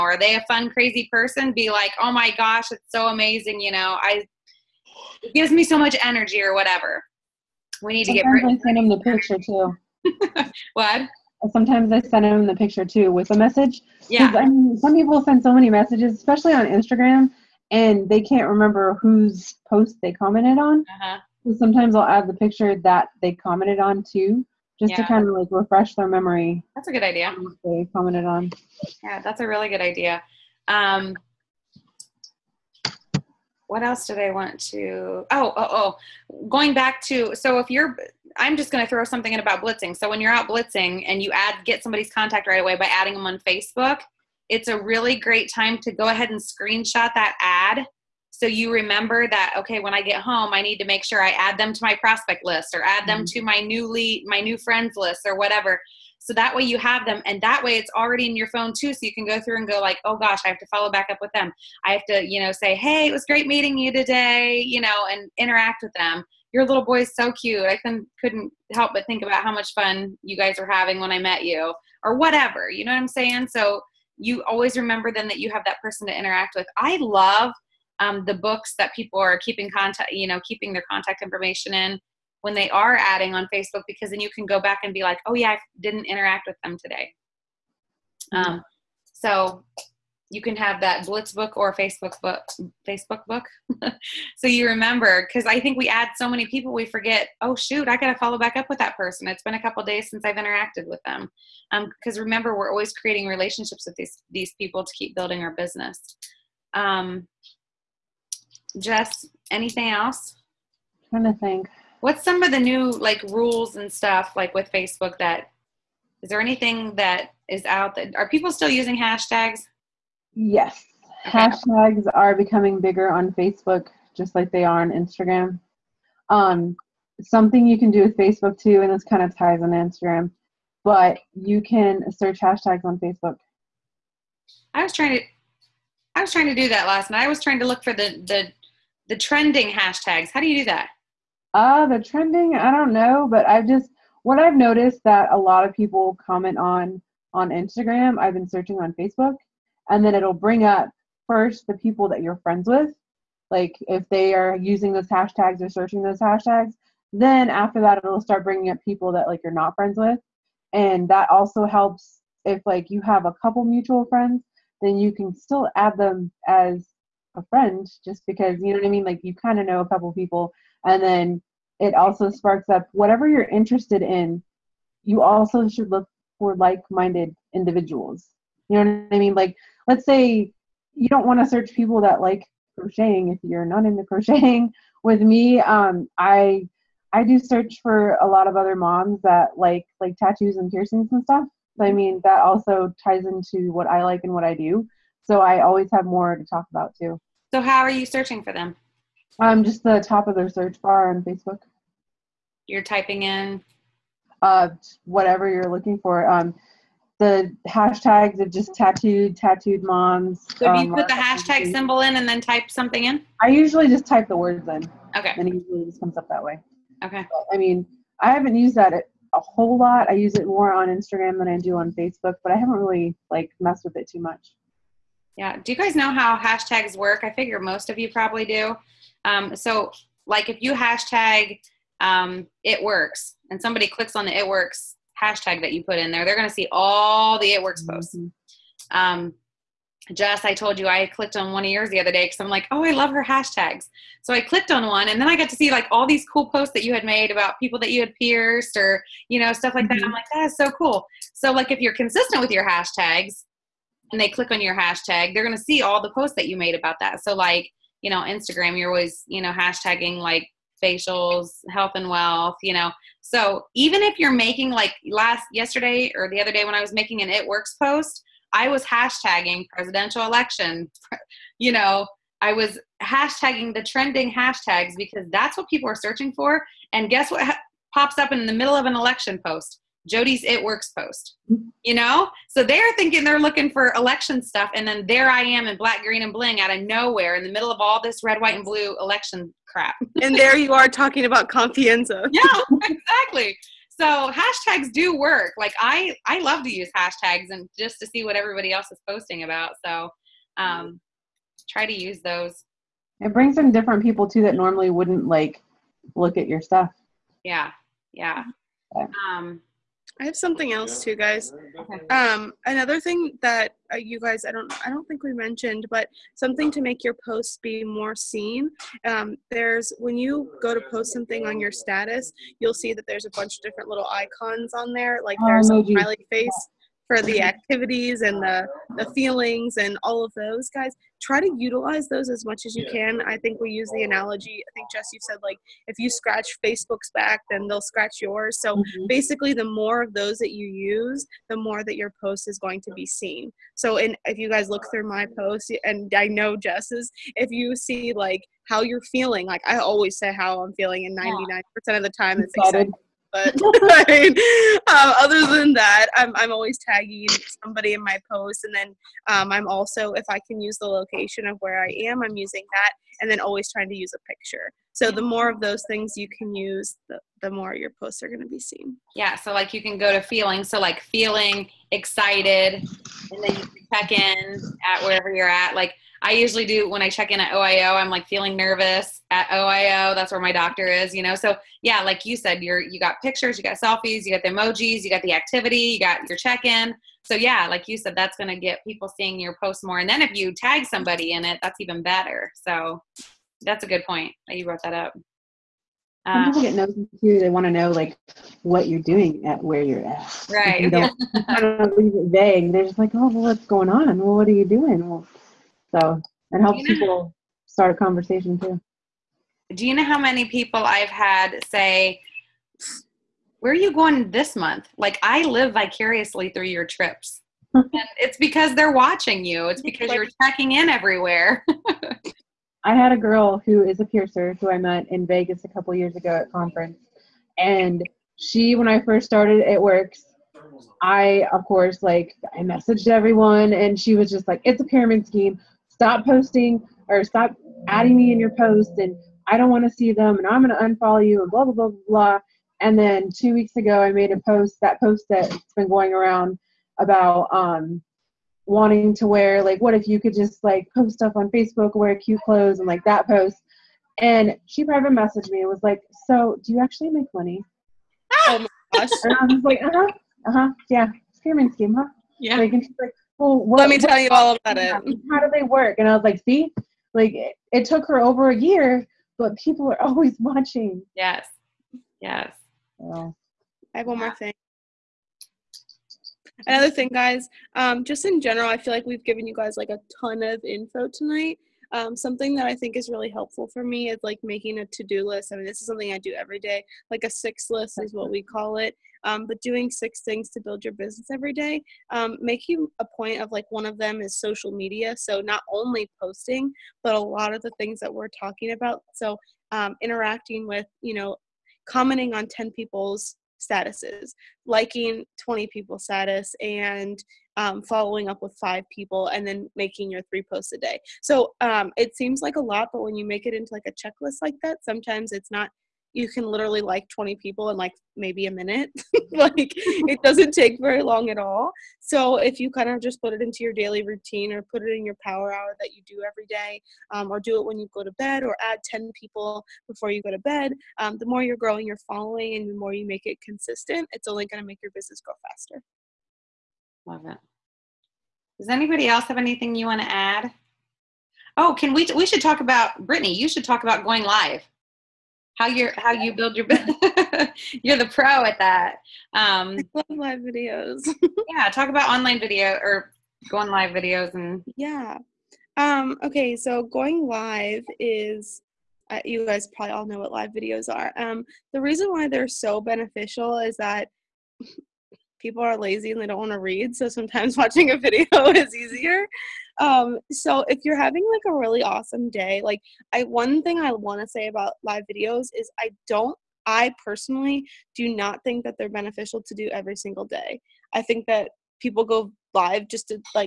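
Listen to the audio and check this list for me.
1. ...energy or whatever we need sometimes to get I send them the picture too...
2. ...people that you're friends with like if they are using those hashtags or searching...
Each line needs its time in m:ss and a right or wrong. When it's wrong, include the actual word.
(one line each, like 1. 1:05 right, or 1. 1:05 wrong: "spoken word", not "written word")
1. 0:06 right
2. 2:31 right.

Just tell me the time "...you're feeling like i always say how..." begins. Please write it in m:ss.
5:48.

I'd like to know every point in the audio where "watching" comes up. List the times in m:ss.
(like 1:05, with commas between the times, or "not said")
6:58, 7:50, 9:27.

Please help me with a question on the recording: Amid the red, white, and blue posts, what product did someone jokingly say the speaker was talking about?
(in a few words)
Confianza.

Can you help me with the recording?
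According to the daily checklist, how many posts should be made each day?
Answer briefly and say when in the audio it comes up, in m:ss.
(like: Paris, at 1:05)
3, at 8:30.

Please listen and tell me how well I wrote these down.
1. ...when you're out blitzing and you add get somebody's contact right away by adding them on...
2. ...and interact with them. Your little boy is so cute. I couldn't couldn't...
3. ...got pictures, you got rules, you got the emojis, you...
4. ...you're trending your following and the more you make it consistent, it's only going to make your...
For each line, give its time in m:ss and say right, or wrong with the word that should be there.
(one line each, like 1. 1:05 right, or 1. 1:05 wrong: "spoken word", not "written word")
1. 0:40 right
2. 1:05 right
3. 6:22 wrong: "selfies", not "rules"
4. 8:51 wrong: "growing", not "trending".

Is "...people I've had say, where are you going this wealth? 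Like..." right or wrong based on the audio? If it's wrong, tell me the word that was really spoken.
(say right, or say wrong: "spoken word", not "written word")
wrong: "month", not "wealth".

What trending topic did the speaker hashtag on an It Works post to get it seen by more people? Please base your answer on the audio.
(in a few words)
presidential election.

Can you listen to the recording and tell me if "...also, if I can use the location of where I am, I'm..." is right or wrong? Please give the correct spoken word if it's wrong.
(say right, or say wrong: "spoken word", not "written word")
right.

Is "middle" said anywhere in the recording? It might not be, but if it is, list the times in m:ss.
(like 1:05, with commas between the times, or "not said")
4:38, 4:47.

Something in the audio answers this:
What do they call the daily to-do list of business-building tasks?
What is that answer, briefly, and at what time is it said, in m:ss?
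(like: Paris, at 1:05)
six list, at 8:07.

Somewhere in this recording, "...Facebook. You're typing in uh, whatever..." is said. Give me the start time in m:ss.
3:21.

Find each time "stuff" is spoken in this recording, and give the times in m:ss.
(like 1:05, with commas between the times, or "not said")
1:53, 3:11, 4:09, 4:44, 5:06, 7:31.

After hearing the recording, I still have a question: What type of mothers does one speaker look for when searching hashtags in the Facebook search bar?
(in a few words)
tattooed moms.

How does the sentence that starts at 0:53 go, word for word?
to my newly, my new friends list or whatever.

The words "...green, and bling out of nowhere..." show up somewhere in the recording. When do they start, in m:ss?
4:46.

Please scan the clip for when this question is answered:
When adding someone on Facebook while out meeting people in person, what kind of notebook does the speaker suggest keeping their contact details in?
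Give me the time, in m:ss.
1:31.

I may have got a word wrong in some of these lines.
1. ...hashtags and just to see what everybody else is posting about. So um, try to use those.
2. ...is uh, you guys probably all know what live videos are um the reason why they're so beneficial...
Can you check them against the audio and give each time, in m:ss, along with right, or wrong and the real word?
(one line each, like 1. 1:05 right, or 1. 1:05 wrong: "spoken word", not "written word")
1. 4:56 right
2. 9:17 right.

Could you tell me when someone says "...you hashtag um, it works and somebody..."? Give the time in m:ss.
3:50.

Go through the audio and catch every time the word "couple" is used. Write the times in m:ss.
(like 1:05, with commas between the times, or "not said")
1:39, 2:43, 2:49, 7:05.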